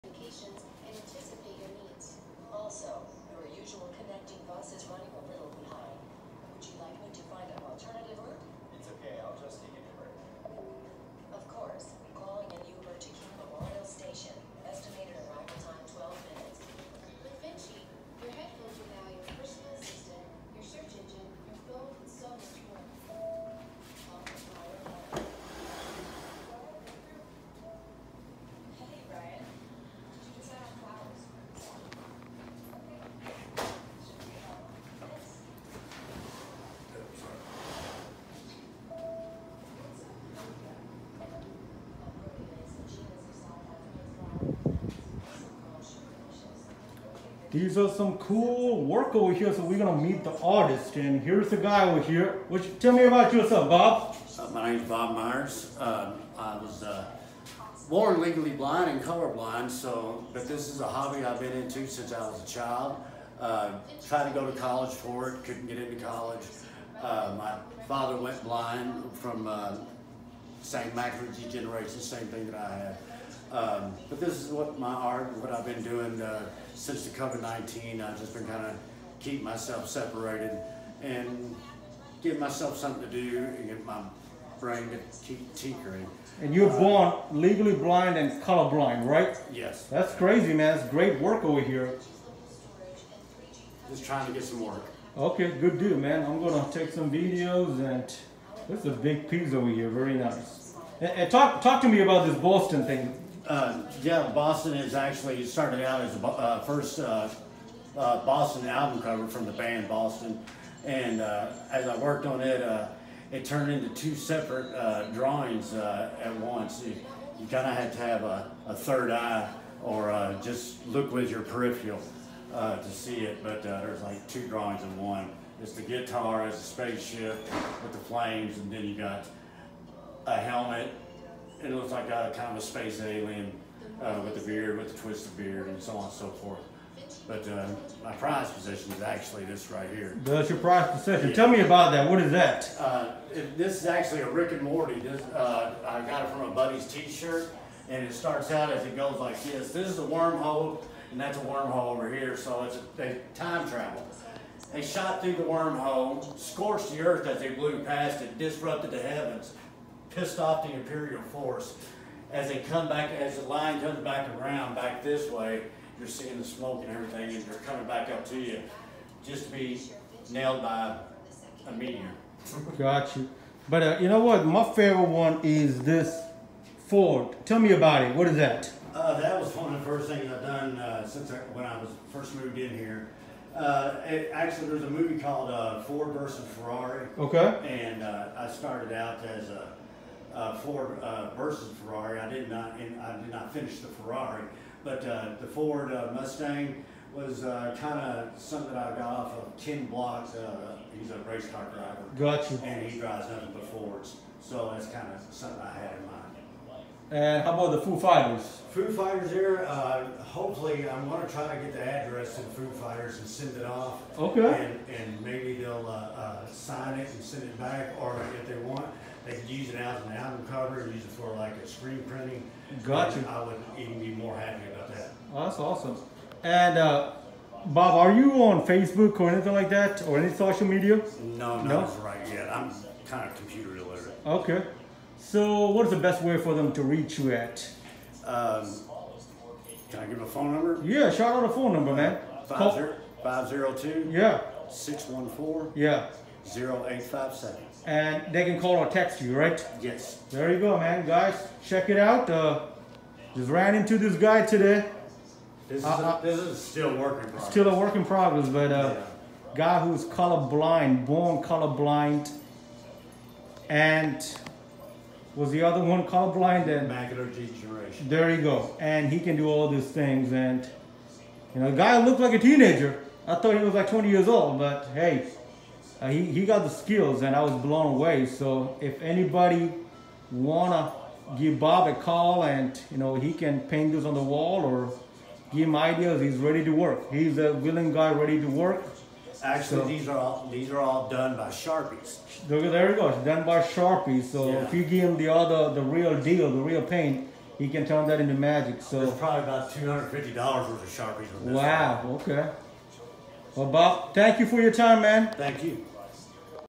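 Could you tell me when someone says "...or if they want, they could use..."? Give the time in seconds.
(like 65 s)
217 s.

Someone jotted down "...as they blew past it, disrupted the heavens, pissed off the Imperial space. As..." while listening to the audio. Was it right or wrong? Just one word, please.
wrong.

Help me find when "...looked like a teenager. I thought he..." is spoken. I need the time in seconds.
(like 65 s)
272 s.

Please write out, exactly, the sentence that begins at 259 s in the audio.
guy who's colorblind, born colorblind, and was the other one colorblind?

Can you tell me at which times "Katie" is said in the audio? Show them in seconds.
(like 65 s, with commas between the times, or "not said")
not said.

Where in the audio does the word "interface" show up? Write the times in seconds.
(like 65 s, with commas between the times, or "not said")
not said.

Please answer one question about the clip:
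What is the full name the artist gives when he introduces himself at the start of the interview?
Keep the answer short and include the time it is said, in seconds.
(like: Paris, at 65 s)
Bob Myers, at 54 s.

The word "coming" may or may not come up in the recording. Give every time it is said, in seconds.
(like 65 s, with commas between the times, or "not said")
167 s.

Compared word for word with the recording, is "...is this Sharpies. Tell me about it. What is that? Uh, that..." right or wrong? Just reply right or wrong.
wrong.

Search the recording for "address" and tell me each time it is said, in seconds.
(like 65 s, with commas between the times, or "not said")
211 s.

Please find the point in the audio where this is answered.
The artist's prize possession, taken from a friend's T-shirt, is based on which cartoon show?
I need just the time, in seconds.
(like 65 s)
144 s.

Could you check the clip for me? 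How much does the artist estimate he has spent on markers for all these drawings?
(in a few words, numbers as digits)
$250.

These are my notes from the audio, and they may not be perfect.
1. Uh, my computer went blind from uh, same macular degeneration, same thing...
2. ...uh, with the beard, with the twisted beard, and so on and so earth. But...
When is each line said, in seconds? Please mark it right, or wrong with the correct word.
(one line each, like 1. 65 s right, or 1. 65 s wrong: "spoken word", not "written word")
1. 67 s wrong: "father", not "computer"
2. 134 s wrong: "forth", not "earth".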